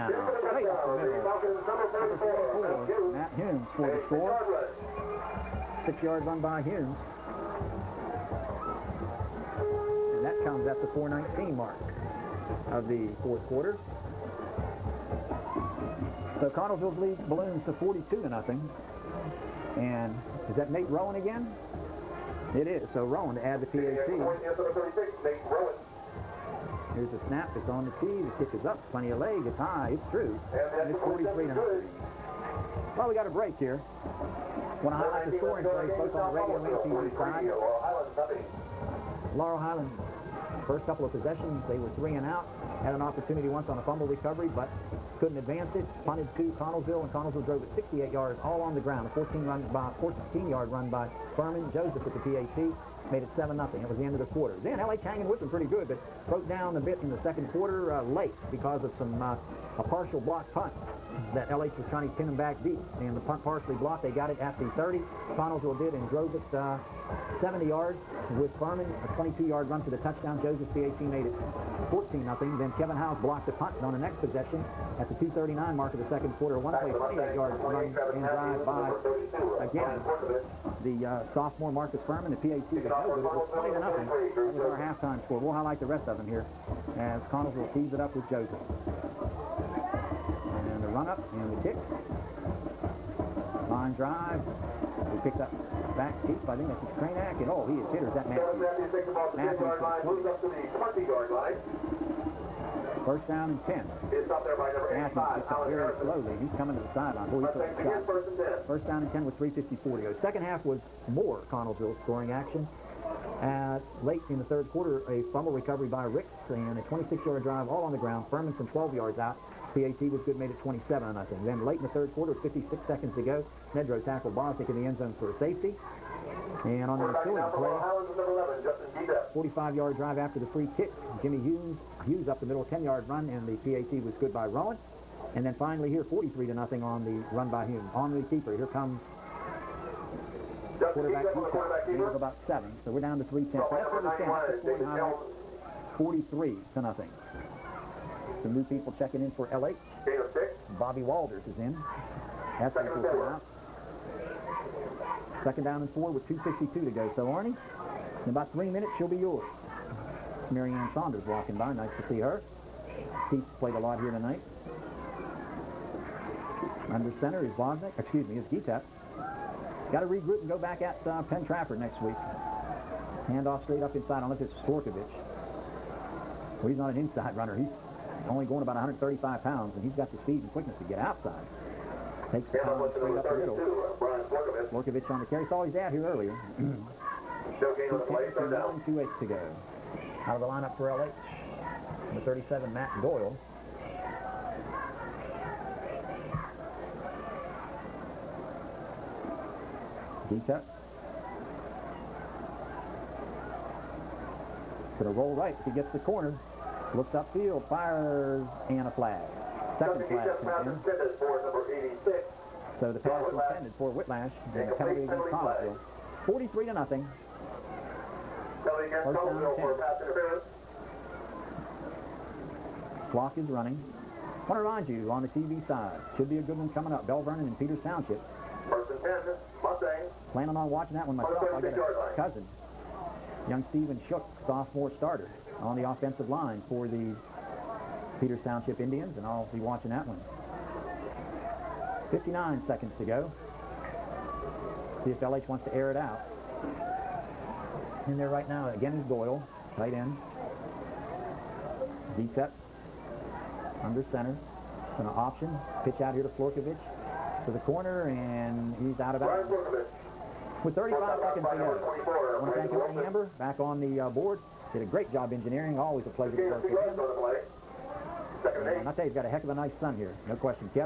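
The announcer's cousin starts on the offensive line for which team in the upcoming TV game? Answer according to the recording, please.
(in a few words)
Peters Township Indians.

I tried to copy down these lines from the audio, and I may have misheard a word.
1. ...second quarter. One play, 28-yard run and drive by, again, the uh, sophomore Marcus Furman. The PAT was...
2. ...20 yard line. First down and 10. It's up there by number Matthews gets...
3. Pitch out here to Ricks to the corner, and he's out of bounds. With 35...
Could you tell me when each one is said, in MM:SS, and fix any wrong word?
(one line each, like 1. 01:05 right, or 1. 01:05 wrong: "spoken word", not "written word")
1. 01:16 right
2. 01:41 right
3. 04:15 wrong: "Florkovich", not "Ricks".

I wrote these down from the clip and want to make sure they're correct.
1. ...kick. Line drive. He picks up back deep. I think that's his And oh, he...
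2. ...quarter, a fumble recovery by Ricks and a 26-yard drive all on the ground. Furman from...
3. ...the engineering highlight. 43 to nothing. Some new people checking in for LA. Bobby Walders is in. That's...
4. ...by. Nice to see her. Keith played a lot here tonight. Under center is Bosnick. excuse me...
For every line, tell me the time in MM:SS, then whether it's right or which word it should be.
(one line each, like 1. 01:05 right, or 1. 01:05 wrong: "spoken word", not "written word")
1. 01:31 right
2. 01:54 right
3. 02:24 wrong: "scoring", not "engineering"
4. 02:41 right.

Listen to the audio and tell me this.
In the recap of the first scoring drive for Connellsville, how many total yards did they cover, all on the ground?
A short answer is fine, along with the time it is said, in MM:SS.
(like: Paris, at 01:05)
68, at 00:47.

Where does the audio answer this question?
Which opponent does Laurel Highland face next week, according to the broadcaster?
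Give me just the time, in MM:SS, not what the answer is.
02:51.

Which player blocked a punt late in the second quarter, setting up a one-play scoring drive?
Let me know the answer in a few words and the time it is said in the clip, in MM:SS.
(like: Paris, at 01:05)
Kevin Howes, at 01:12.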